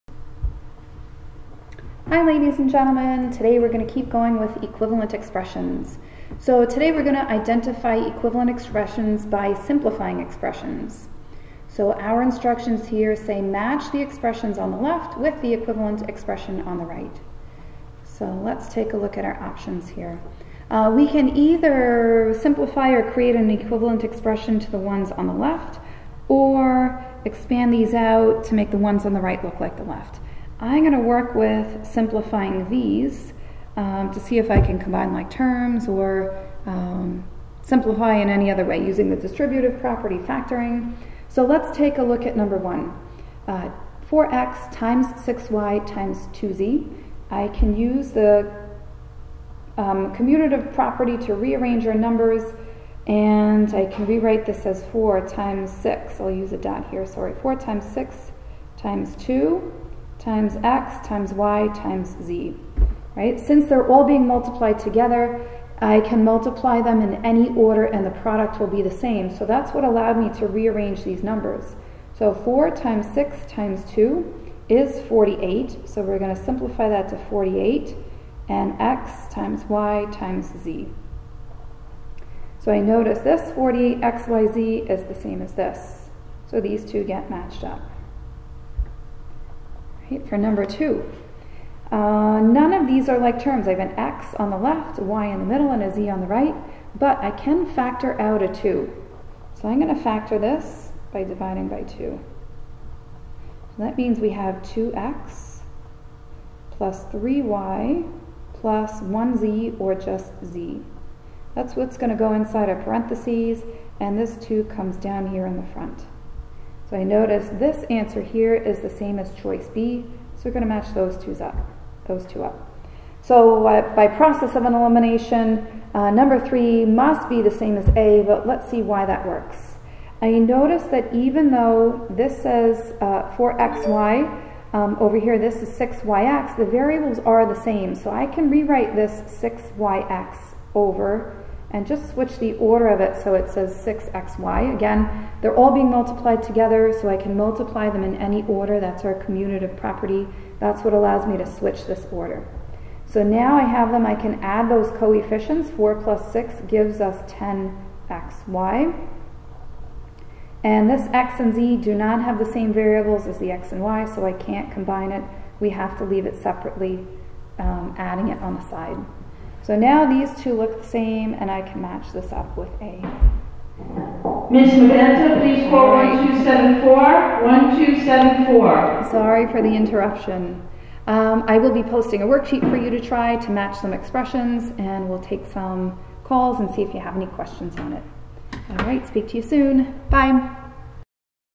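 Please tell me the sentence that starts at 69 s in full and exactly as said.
So that's what allowed me to rearrange these numbers.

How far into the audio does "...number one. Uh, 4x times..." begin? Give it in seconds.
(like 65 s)
42 s.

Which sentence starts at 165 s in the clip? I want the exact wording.
We have to leave it separately, um, adding it on the side.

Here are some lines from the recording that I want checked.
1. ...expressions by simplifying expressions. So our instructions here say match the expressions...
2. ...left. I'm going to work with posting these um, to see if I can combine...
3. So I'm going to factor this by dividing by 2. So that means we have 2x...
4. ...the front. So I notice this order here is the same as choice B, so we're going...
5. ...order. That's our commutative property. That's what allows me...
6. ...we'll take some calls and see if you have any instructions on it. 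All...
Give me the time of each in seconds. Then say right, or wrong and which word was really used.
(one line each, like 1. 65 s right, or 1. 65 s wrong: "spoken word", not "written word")
1. 8 s right
2. 29 s wrong: "simplifying", not "posting"
3. 99 s right
4. 115 s wrong: "answer", not "order"
5. 148 s right
6. 185 s wrong: "questions", not "instructions".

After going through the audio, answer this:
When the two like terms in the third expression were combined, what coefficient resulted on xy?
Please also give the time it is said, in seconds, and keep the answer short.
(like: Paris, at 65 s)
10, at 157 s.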